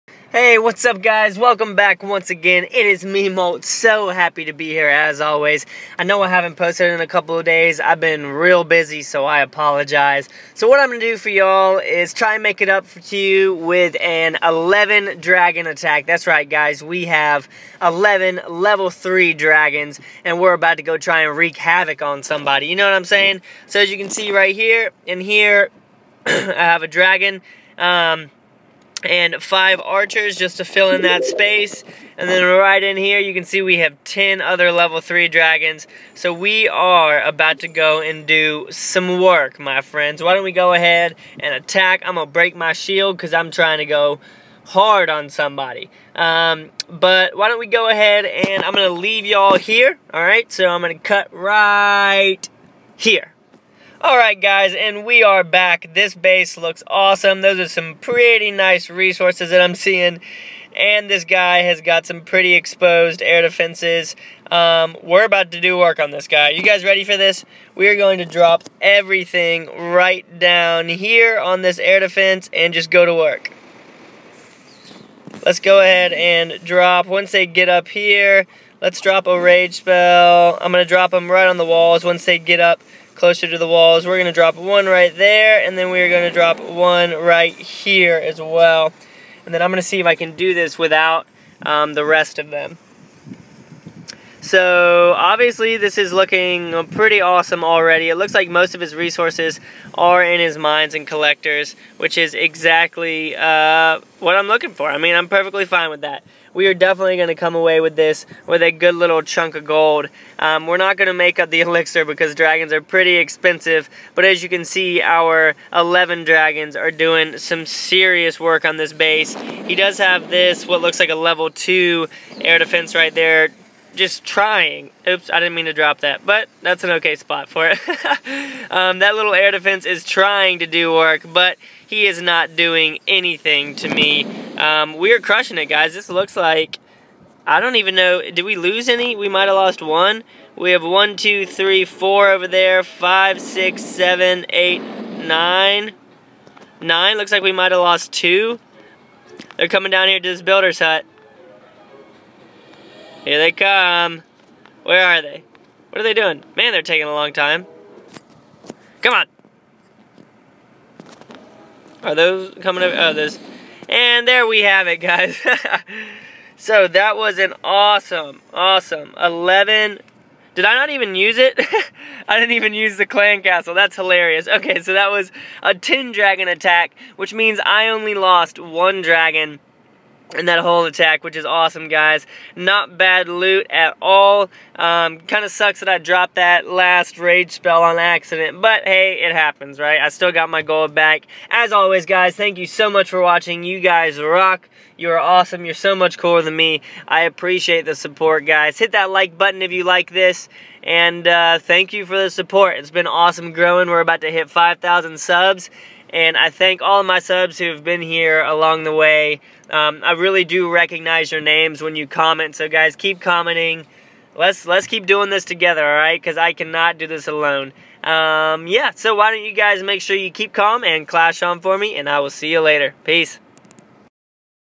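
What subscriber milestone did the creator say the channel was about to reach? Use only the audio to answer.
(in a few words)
5,000.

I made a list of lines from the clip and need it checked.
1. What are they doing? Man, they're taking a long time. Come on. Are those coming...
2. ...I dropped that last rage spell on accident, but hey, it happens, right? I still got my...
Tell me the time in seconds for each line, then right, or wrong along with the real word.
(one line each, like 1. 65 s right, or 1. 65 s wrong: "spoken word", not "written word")
1. 155 s right
2. 185 s right.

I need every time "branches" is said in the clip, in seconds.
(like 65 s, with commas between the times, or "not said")
not said.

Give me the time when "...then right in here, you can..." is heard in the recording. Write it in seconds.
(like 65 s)
32 s.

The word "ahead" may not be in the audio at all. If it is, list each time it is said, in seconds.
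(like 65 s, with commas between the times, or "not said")
40 s, 47 s, 75 s.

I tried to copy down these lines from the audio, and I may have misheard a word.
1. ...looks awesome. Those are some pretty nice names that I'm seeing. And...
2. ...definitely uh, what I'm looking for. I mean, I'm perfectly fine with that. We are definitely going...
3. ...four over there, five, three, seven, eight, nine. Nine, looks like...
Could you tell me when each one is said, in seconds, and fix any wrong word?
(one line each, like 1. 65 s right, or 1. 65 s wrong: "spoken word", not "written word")
1. 56 s wrong: "resources", not "names"
2. 102 s wrong: "exactly", not "definitely"
3. 141 s wrong: "six", not "three".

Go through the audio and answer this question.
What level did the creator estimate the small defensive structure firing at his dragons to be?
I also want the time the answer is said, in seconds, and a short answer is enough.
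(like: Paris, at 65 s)
Level 2, at 121 s.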